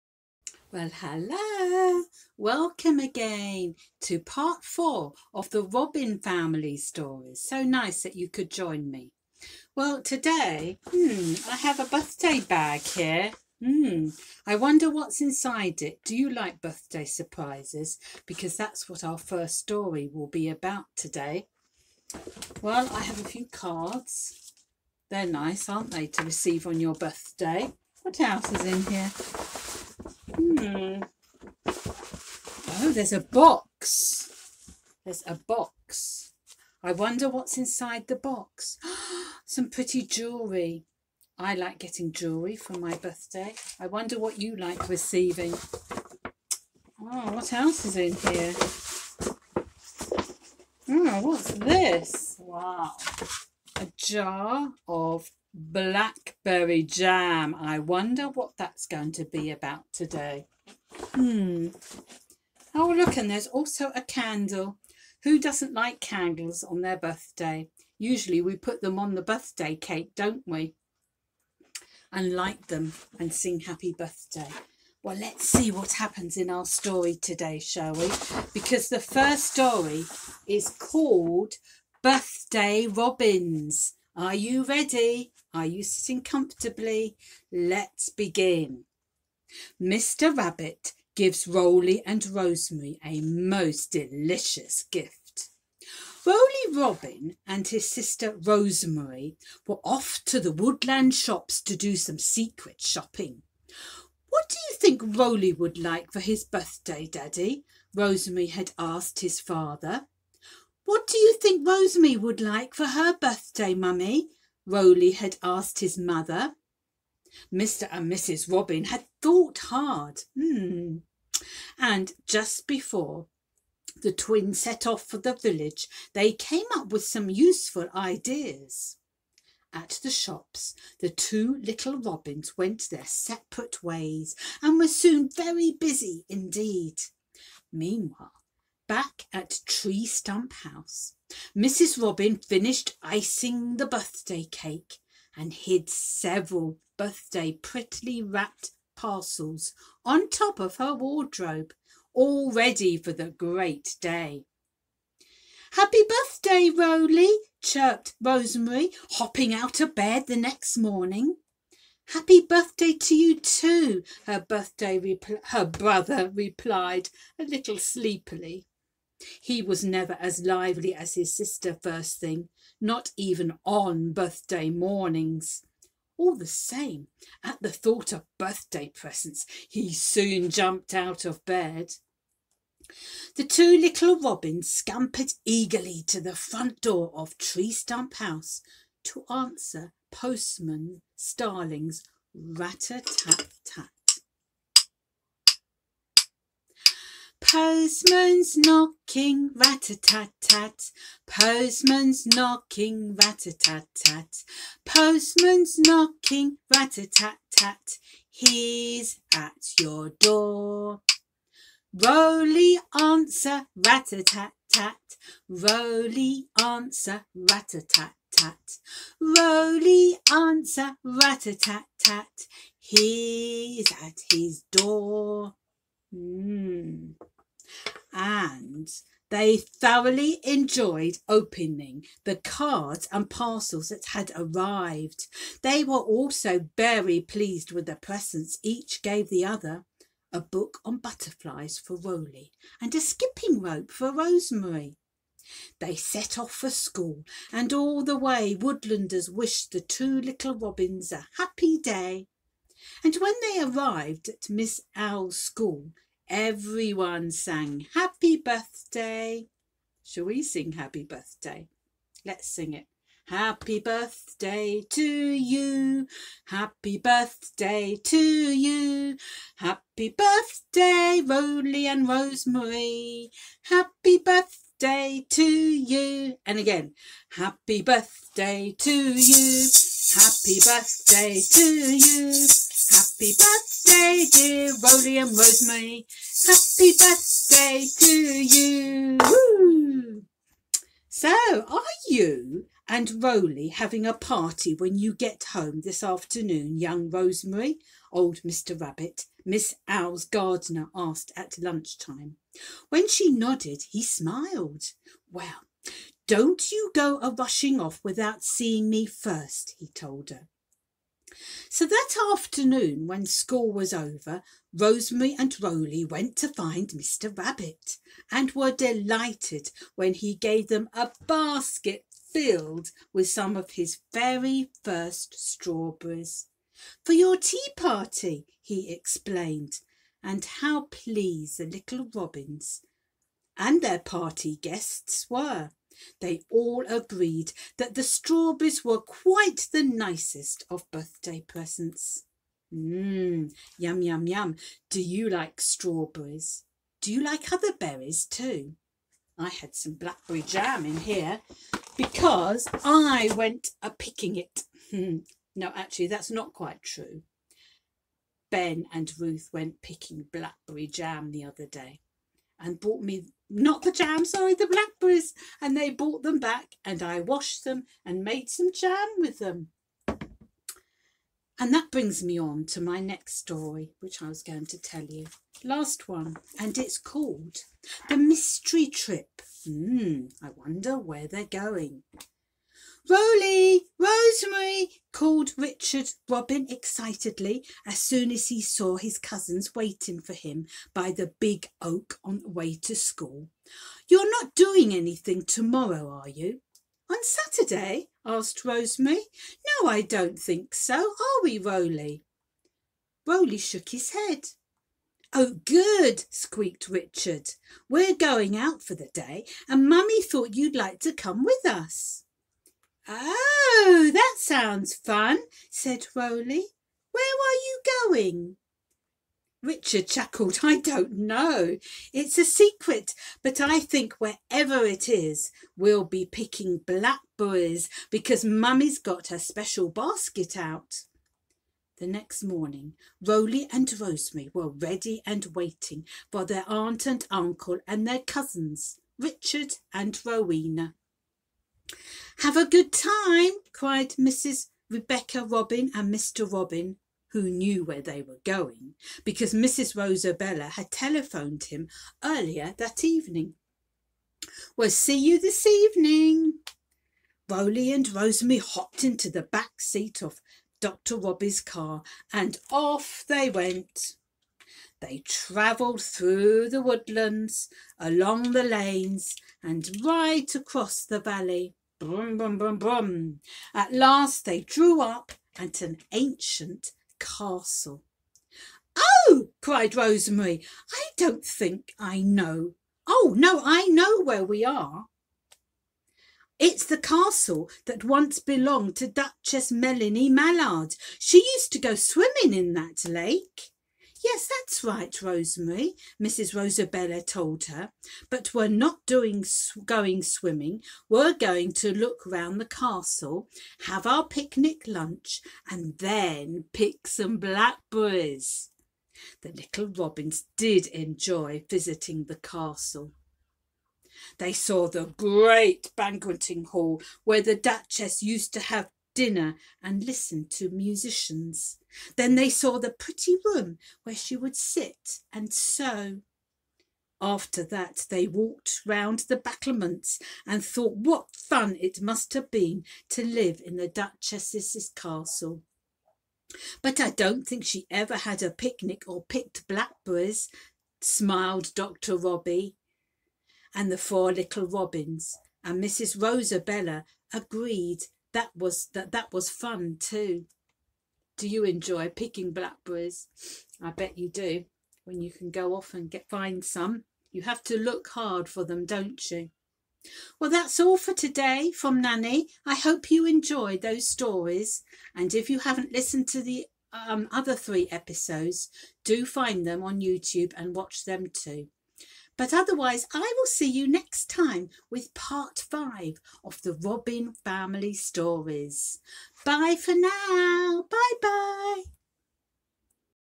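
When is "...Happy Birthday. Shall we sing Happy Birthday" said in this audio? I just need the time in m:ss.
4:17.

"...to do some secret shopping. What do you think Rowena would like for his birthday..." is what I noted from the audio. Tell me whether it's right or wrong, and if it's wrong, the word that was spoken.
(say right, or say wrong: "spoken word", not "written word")
wrong: "Roly", not "Rowena".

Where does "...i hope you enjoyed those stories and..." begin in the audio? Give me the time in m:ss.
9:22.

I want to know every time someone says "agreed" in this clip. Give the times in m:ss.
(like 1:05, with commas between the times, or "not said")
5:36, 9:07.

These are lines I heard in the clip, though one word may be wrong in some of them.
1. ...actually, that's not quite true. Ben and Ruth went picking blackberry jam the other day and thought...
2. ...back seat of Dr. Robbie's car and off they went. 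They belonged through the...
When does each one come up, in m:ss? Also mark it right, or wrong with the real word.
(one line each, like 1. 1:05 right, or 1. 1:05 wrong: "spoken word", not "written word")
1. 5:55 wrong: "brought", not "thought"
2. 7:39 wrong: "travelled", not "belonged".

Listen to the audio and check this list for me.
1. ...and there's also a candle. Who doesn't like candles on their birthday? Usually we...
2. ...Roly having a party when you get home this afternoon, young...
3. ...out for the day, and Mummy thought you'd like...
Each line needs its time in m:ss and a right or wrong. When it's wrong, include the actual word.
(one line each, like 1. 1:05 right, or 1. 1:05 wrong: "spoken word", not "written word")
1. 1:03 right
2. 4:53 right
3. 6:48 right.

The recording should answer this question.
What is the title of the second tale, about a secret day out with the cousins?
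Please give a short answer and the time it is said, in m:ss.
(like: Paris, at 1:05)
The Mystery Trip, at 6:18.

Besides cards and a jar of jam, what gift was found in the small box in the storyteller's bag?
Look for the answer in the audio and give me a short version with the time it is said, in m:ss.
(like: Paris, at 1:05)
Pretty jewellery, at 0:39.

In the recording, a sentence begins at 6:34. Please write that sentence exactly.
You're not doing anything tomorrow, are you?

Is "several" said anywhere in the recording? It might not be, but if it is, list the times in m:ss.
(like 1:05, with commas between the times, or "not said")
2:25.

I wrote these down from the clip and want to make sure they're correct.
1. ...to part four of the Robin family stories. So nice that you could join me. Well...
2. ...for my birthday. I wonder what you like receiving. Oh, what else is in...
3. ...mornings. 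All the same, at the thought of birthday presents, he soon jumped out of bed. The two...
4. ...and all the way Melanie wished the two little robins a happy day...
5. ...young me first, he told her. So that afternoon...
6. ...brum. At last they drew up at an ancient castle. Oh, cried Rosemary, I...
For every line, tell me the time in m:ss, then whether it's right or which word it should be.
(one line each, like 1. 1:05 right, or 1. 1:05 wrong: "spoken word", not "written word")
1. 0:04 right
2. 0:42 right
3. 2:54 right
4. 4:07 wrong: "Woodlanders", not "Melanie"
5. 5:08 wrong: "seeing", not "young"
6. 7:52 right.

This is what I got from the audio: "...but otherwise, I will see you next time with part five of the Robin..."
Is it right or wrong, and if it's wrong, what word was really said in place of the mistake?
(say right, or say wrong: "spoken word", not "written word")
right.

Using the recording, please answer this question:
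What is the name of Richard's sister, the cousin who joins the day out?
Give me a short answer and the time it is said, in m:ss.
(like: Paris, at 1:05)
Rowena, at 7:20.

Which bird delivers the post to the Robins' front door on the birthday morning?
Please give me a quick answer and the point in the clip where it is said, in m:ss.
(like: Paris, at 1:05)
Postman Starling, at 3:10.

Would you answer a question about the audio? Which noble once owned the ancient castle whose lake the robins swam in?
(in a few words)
Duchess Melanie Mallard.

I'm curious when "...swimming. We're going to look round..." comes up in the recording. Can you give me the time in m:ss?
8:20.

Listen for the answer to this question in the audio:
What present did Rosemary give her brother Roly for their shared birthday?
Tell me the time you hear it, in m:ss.
4:00.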